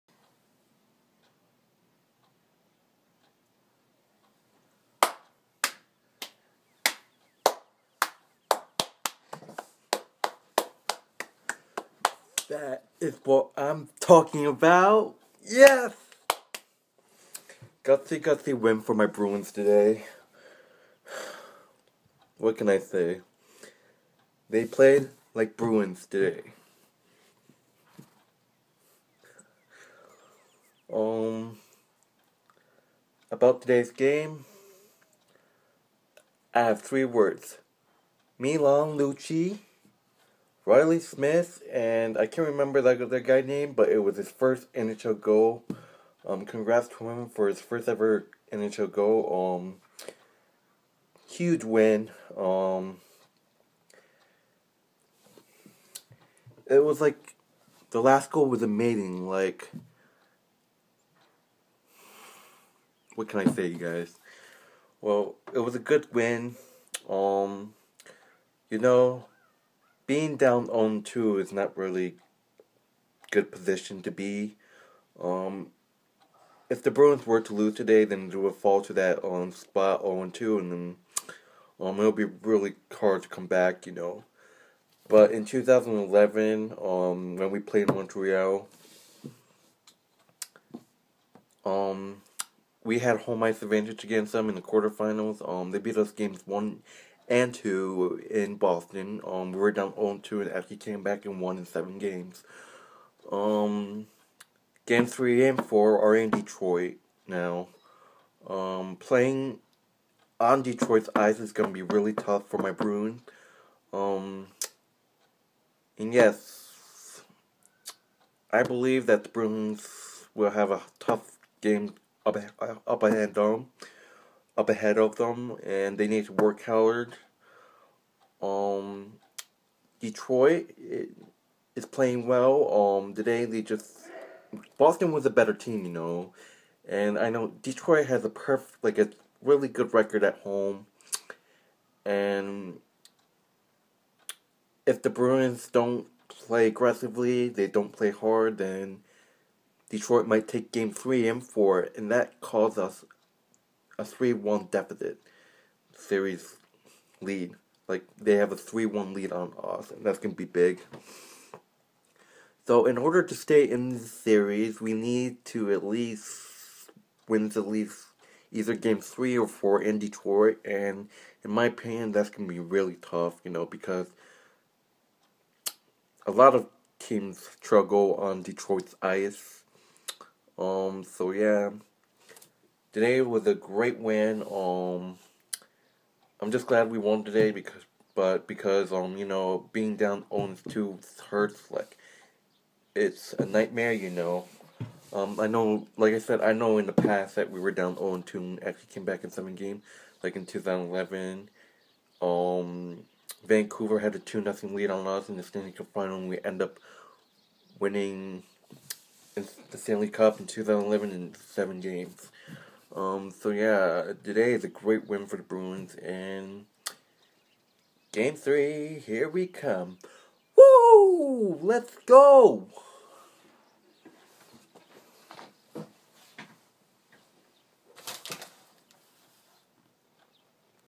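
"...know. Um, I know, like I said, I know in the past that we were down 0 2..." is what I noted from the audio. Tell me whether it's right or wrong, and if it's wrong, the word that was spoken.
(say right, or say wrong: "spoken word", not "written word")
right.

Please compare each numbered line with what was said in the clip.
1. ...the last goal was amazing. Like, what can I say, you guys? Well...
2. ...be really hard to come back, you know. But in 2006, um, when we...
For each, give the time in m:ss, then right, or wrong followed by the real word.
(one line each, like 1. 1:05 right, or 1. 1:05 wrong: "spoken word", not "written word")
1. 0:57 right
2. 1:22 wrong: "2011", not "2006".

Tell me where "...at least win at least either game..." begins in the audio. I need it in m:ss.
2:45.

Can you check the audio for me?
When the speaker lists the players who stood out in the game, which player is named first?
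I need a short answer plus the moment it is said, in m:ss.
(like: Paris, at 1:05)
Milan Lucic, at 0:38.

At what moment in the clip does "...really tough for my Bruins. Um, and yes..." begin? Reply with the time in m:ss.
1:51.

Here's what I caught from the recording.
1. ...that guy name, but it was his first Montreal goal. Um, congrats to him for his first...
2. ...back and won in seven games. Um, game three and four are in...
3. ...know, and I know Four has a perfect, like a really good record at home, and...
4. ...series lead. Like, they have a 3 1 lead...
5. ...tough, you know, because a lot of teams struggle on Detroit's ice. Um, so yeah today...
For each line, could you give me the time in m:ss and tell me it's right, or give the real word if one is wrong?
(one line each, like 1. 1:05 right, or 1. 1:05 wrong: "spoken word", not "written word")
1. 0:43 wrong: "NHL", not "Montreal"
2. 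1:41 right
3. 2:15 wrong: "Detroit", not "Four"
4. 2:35 right
5. 2:53 right.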